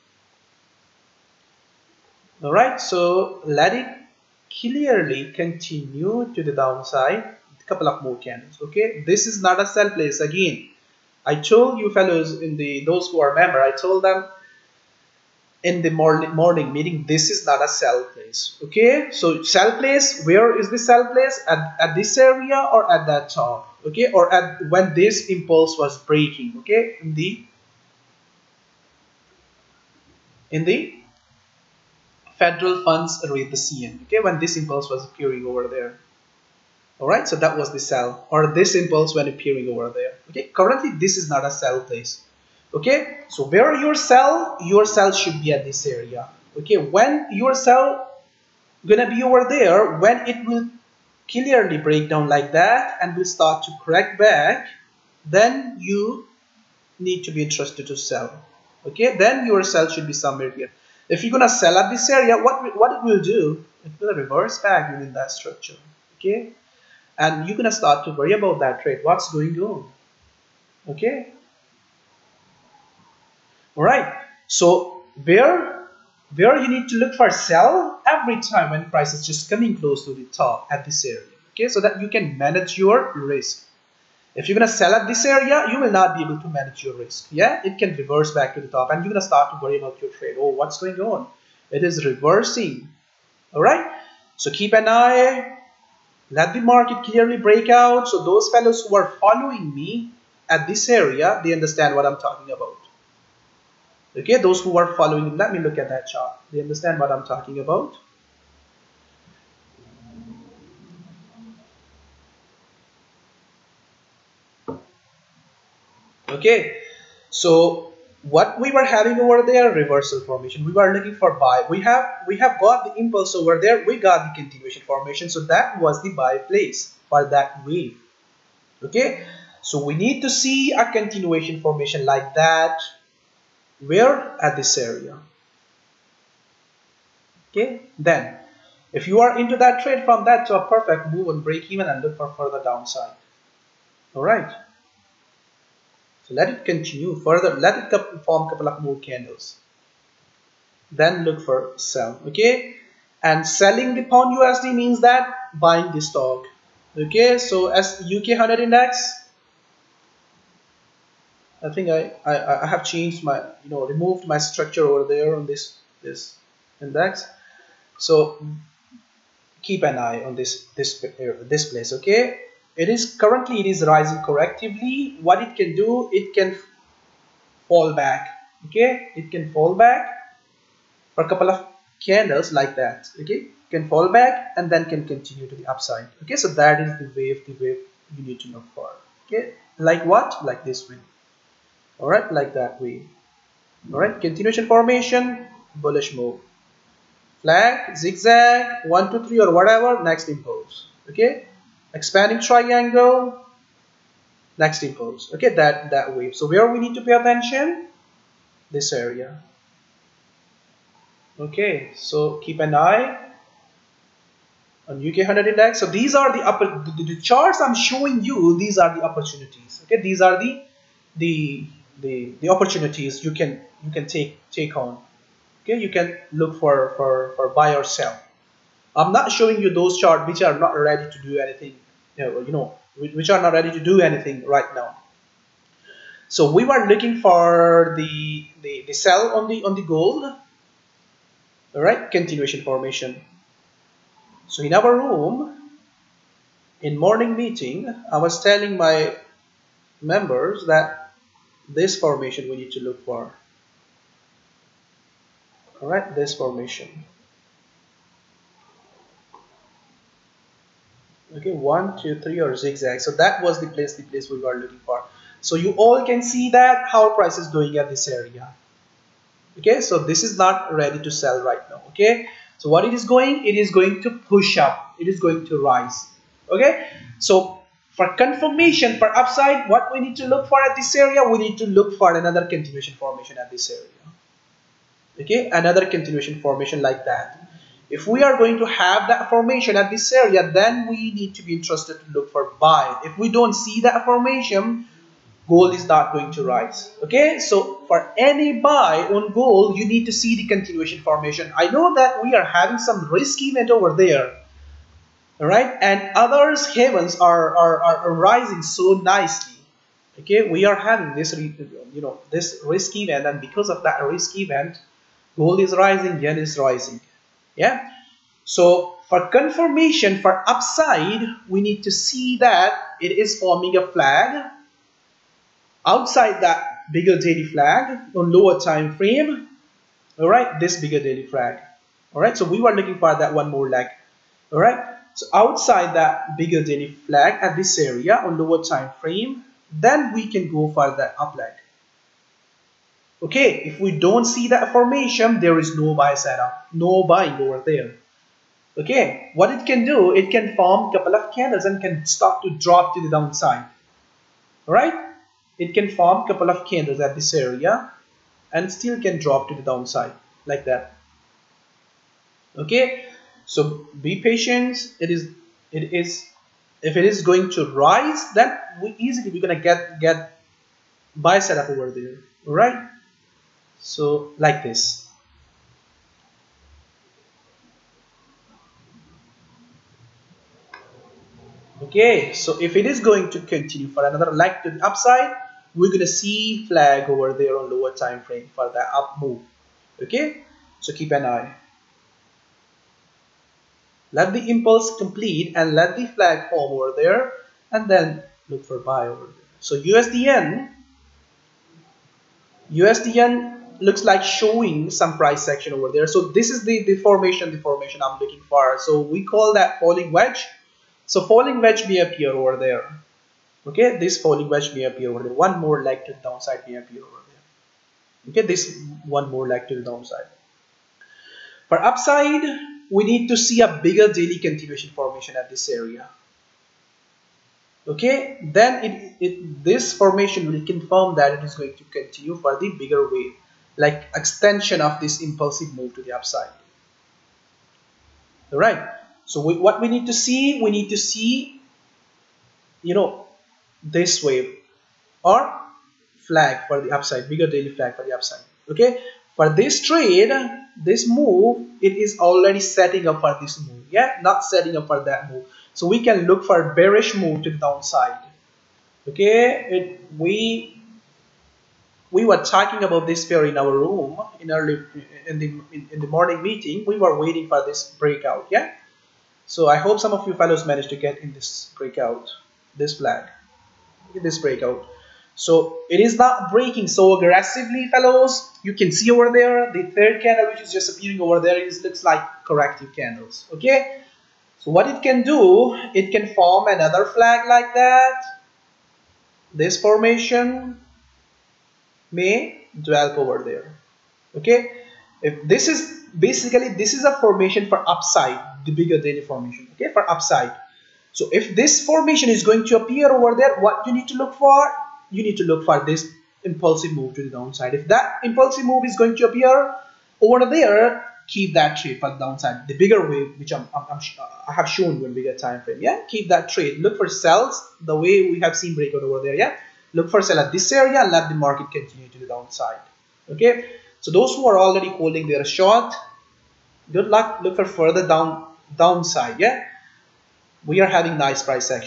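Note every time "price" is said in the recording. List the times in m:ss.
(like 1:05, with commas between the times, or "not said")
1:18, 4:27, 6:45.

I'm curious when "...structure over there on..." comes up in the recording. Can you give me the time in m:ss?
2:44.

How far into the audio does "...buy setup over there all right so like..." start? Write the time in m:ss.
6:11.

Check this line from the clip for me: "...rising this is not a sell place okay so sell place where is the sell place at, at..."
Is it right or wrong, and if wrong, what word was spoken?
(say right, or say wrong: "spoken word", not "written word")
wrong: "meeting", not "rising".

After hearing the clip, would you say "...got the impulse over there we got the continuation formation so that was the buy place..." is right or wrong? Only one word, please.
right.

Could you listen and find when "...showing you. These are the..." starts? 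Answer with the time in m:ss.
3:37.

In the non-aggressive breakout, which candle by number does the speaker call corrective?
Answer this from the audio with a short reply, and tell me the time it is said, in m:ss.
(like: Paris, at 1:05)
third, at 7:59.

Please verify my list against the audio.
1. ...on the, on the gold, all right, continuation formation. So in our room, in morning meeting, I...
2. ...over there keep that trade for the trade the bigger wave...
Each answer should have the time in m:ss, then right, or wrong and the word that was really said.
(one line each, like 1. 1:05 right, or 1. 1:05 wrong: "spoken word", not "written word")
1. 3:59 right
2. 8:30 wrong: "downside", not "trade".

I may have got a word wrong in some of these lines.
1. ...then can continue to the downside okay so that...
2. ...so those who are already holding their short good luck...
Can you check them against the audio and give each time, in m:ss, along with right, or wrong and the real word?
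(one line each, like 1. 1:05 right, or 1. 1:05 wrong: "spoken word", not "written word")
1. 3:04 wrong: "upside", not "downside"
2. 8:43 right.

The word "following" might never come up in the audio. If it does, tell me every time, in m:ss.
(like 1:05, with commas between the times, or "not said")
1:39, 1:44.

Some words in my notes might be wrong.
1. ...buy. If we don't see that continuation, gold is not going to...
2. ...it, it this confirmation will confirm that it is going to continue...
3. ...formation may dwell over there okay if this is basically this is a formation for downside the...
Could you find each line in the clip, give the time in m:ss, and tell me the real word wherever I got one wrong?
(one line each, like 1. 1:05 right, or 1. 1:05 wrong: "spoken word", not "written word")
1. 4:52 wrong: "formation", not "continuation"
2. 7:08 wrong: "formation", not "confirmation"
3. 8:09 wrong: "upside", not "downside".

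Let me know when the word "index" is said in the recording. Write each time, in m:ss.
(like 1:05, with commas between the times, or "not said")
2:38, 2:46, 3:35.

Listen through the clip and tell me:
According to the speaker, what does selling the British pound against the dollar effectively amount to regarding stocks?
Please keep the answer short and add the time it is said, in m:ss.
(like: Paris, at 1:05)
buying the stock, at 2:35.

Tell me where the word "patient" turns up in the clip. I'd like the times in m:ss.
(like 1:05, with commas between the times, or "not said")
6:04.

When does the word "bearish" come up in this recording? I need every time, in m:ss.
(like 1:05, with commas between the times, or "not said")
7:36.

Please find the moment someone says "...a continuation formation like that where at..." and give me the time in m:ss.
2:10.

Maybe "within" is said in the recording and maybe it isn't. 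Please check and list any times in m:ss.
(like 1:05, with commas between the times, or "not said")
1:04.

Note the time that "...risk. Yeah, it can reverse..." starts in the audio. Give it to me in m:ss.
1:26.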